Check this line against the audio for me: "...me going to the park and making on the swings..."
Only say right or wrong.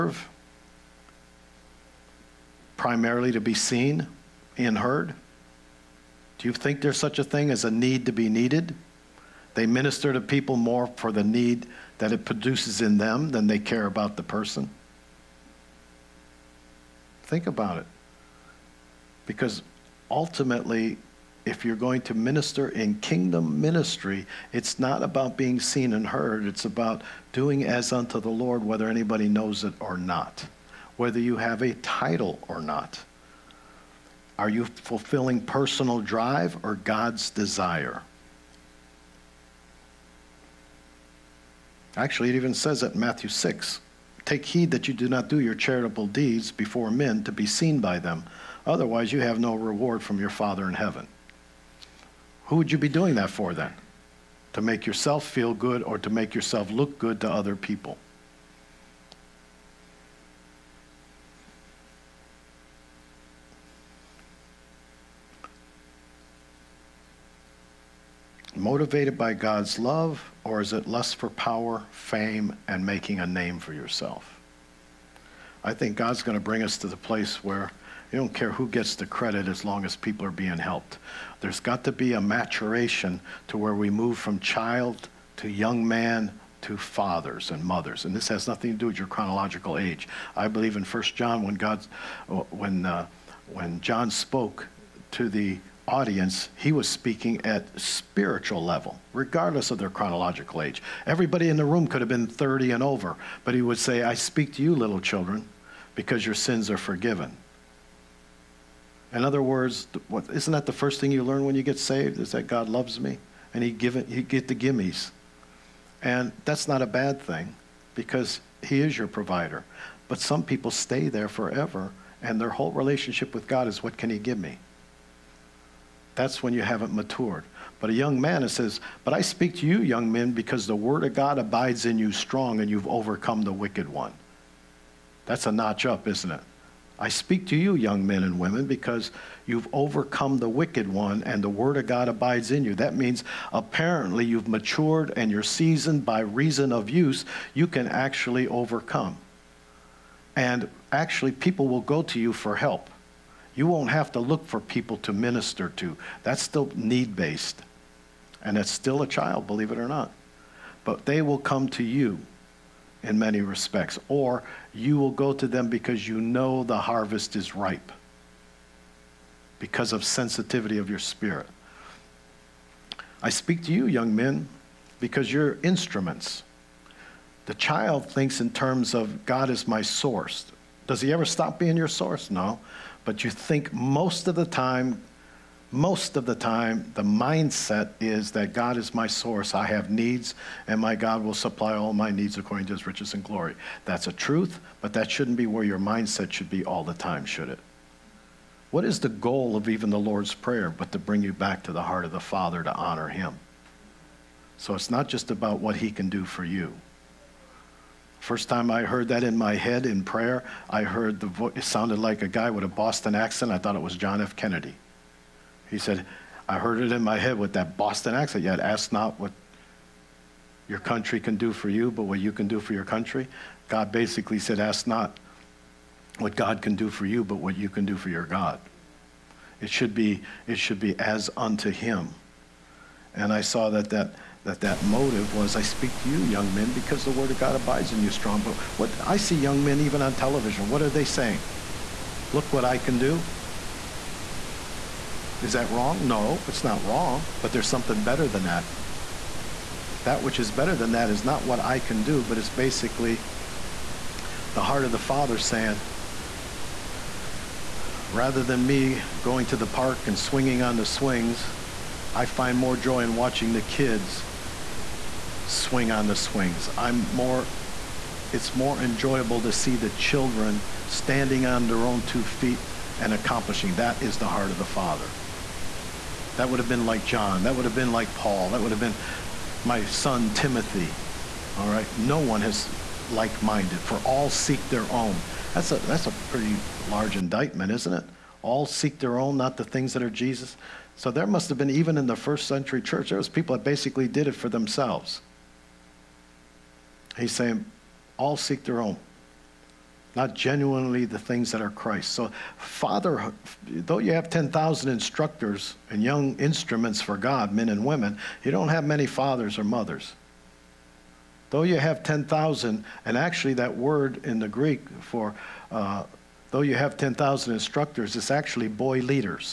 wrong.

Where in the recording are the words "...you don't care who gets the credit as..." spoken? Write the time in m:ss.
1:18.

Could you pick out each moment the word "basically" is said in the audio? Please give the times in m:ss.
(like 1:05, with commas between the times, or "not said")
3:43, 4:12, 4:53.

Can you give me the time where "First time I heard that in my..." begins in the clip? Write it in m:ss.
3:28.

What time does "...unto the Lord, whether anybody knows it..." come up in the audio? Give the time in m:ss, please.
0:27.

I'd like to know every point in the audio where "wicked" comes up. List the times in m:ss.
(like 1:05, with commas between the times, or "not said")
2:13, 2:20.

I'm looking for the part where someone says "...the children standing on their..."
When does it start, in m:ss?
4:29.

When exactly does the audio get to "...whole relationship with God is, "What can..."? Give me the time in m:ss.
2:02.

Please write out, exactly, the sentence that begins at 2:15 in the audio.
That's a notch up, isn't it?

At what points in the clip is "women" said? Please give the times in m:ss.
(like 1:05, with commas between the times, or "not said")
2:18, 5:07.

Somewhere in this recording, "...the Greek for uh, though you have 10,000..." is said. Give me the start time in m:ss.
5:14.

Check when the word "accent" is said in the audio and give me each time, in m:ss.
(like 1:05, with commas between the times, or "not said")
3:33, 3:38.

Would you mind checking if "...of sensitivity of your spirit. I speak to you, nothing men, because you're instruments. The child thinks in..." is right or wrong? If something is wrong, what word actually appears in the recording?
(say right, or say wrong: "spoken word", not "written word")
wrong: "young", not "nothing".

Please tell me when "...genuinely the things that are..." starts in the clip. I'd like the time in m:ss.
5:00.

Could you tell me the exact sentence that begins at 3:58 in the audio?
But what I see young men even on television, what are they saying?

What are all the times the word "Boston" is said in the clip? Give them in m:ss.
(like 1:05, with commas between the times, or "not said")
3:32, 3:37.